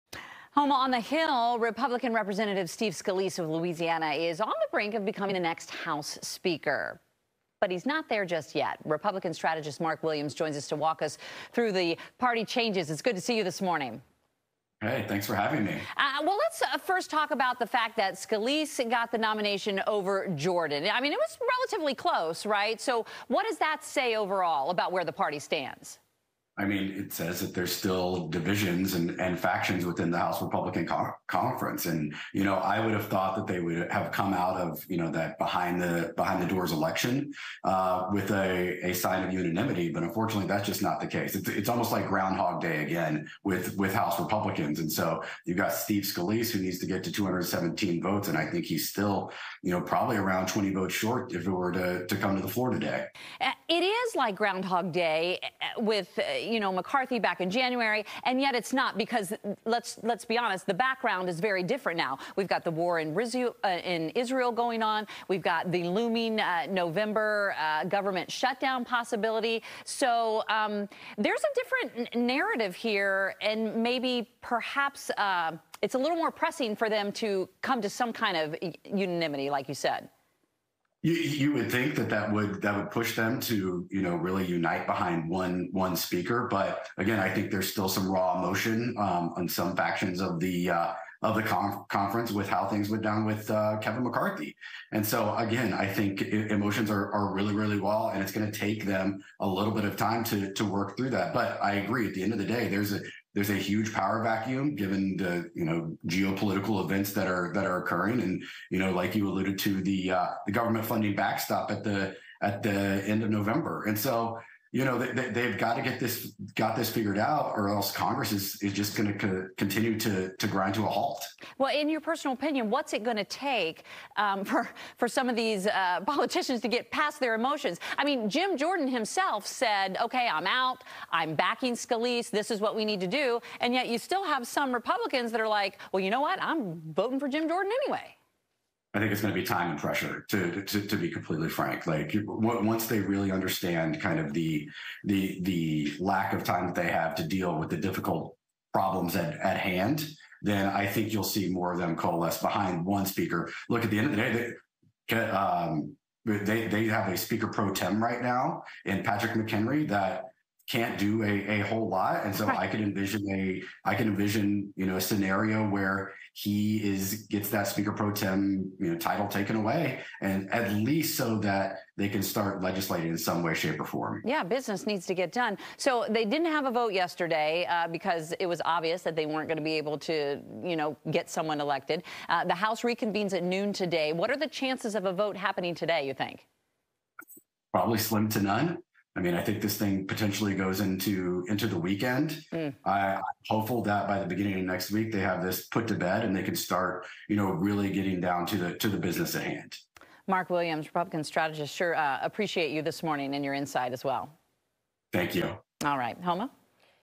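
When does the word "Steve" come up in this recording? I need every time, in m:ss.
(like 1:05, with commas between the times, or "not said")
0:02, 0:45.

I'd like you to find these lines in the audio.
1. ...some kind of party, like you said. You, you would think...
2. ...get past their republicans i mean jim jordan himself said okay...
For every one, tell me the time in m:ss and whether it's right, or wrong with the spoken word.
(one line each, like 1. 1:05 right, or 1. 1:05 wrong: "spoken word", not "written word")
1. 1:17 wrong: "unanimity", not "party"
2. 2:06 wrong: "emotions", not "republicans".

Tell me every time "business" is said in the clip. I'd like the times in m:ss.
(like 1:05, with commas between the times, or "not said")
2:54, 3:18.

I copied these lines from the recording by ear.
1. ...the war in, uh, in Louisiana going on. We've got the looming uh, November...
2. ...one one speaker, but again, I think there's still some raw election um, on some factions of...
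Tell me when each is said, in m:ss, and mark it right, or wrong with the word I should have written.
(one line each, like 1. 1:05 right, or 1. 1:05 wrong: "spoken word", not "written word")
1. 1:02 wrong: "Israel", not "Louisiana"
2. 1:25 wrong: "emotion", not "election".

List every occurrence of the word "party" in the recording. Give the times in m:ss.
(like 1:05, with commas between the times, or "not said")
0:12, 0:25.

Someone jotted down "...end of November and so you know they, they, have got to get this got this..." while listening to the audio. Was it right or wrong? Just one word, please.
right.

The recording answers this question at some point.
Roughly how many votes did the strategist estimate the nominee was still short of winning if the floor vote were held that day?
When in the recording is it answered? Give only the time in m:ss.
0:50.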